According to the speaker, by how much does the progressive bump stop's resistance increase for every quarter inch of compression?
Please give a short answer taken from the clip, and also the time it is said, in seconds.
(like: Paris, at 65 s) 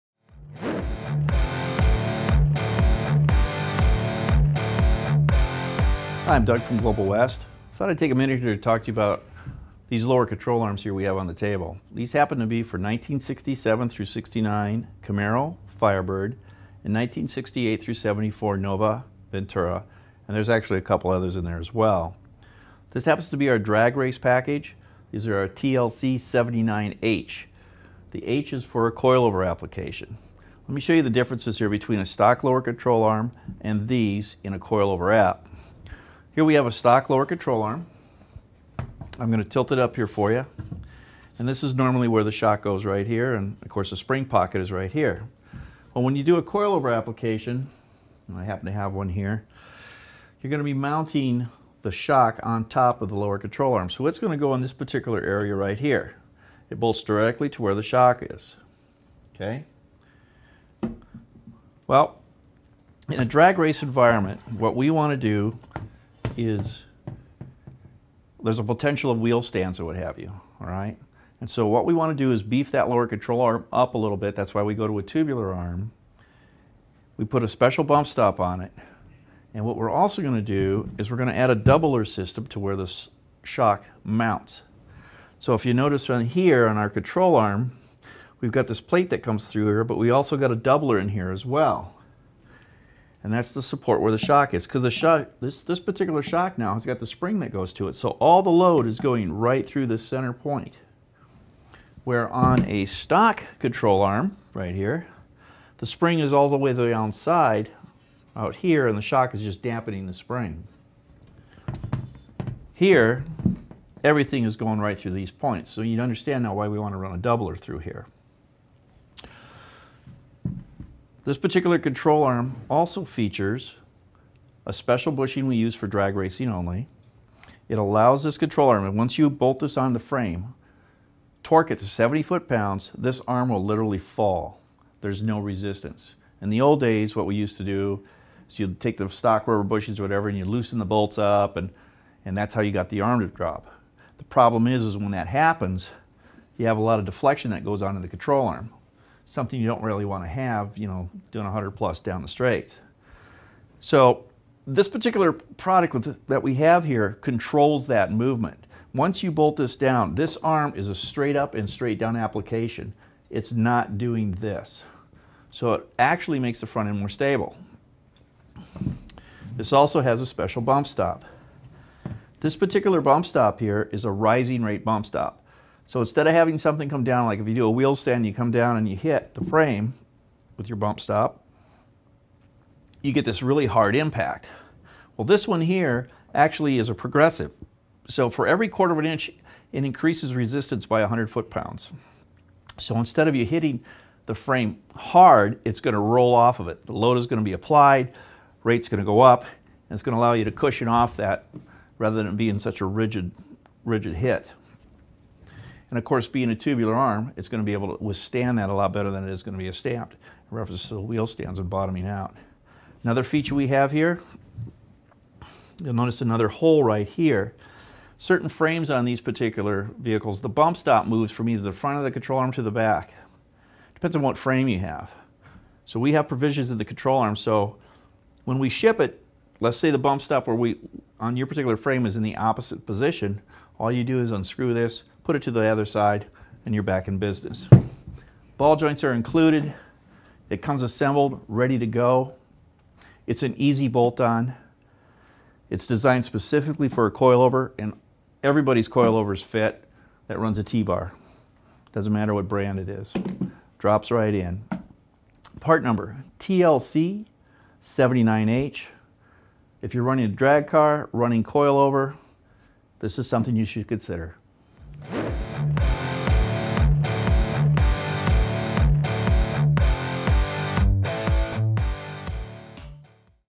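100 foot-pounds, at 191 s.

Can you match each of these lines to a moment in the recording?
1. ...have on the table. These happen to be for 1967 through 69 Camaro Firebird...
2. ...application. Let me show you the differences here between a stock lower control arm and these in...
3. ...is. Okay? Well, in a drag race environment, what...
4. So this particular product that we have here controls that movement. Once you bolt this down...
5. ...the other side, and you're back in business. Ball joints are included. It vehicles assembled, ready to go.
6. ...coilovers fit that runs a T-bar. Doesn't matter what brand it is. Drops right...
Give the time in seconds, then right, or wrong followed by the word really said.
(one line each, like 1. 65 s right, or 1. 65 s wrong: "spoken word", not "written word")
1. 11 s right
2. 29 s right
3. 58 s right
4. 153 s right
5. 235 s wrong: "comes", not "vehicles"
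6. 248 s right.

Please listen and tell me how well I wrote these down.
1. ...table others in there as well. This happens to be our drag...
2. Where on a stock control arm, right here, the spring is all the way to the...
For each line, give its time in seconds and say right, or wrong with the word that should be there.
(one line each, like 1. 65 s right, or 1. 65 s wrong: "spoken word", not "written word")
1. 20 s wrong: "couple", not "table"
2. 102 s right.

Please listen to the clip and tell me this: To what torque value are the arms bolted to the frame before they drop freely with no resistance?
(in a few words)
70 foot-pounds.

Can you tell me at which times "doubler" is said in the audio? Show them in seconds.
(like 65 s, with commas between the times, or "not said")
81 s, 90 s, 117 s.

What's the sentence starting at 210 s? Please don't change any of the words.
In reference to the wheel stands and bottoming out.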